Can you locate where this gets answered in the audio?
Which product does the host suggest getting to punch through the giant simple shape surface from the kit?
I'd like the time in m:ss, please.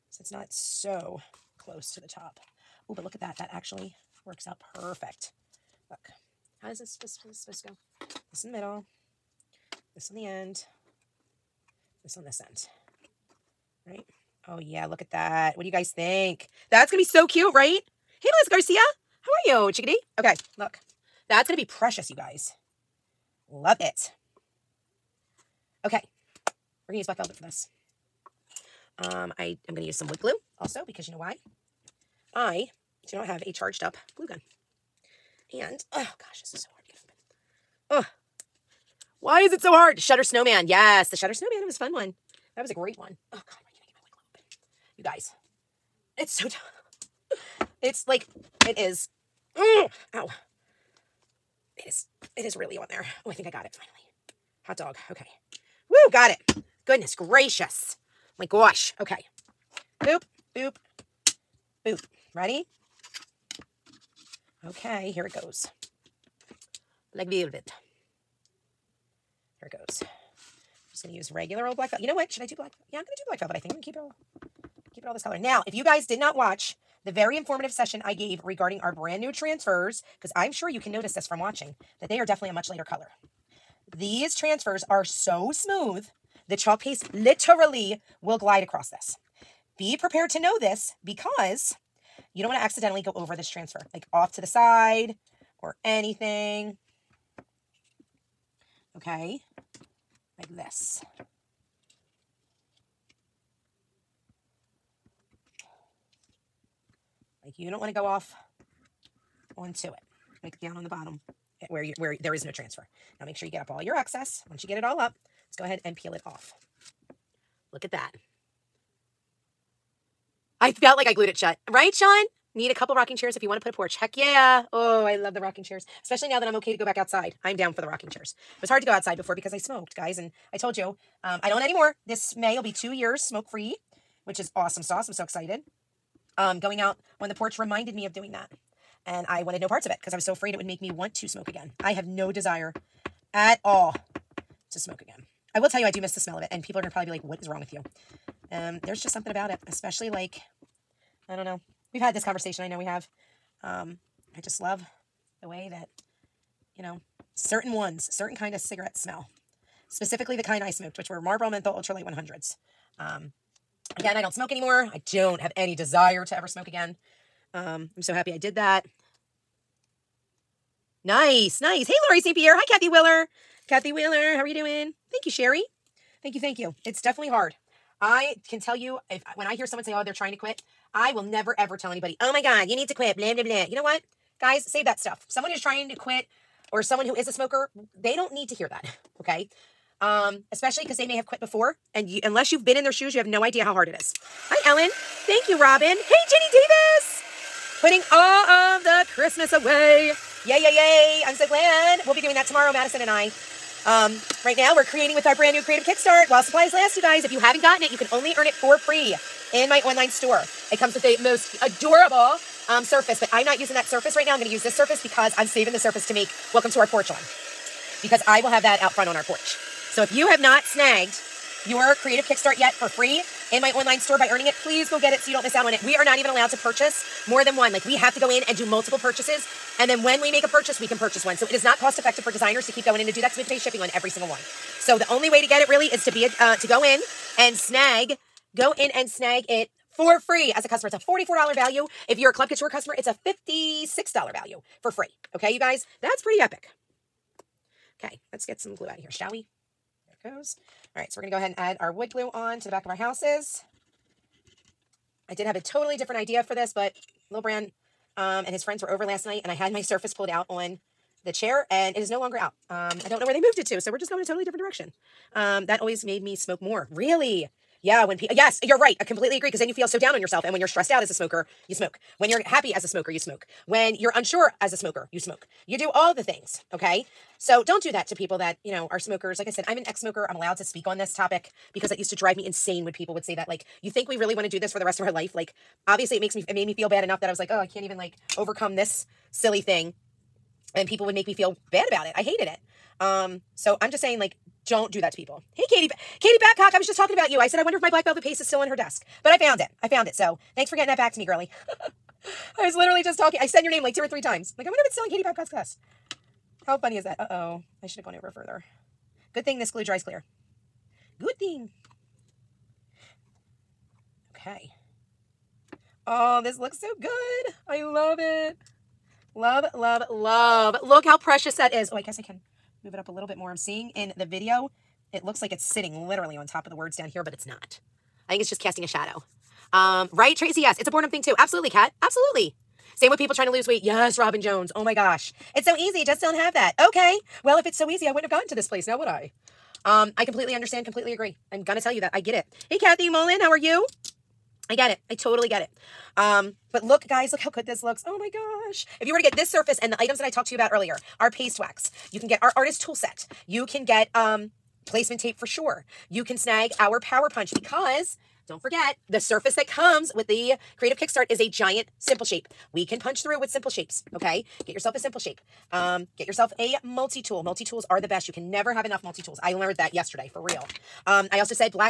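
5:56.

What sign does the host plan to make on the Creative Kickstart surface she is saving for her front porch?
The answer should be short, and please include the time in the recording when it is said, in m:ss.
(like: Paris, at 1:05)
Welcome to Our Porch, at 3:36.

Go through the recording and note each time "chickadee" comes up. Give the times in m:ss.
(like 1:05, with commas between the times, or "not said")
0:19.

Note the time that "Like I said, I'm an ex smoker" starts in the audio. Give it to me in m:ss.
4:39.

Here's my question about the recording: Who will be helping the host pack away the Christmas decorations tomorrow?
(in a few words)
Madison.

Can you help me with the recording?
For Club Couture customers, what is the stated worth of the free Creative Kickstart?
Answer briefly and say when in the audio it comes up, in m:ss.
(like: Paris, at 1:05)
$56, at 4:03.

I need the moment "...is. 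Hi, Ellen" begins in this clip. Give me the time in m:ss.
3:13.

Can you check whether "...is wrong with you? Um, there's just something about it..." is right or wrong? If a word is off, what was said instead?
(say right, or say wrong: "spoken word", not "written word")
right.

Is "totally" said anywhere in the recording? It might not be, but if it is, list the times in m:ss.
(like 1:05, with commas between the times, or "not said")
4:15, 4:24, 5:45.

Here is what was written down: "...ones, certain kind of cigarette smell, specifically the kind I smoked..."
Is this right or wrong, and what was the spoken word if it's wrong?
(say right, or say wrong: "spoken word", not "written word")
right.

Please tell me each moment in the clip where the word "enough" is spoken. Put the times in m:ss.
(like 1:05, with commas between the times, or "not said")
4:47, 6:08.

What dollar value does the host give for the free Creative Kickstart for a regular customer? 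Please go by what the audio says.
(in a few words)
$44.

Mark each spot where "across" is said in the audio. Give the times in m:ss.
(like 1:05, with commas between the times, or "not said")
1:28.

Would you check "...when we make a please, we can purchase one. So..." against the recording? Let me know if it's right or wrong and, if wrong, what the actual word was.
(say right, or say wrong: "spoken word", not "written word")
wrong: "purchase", not "please".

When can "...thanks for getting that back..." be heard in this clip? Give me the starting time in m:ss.
5:00.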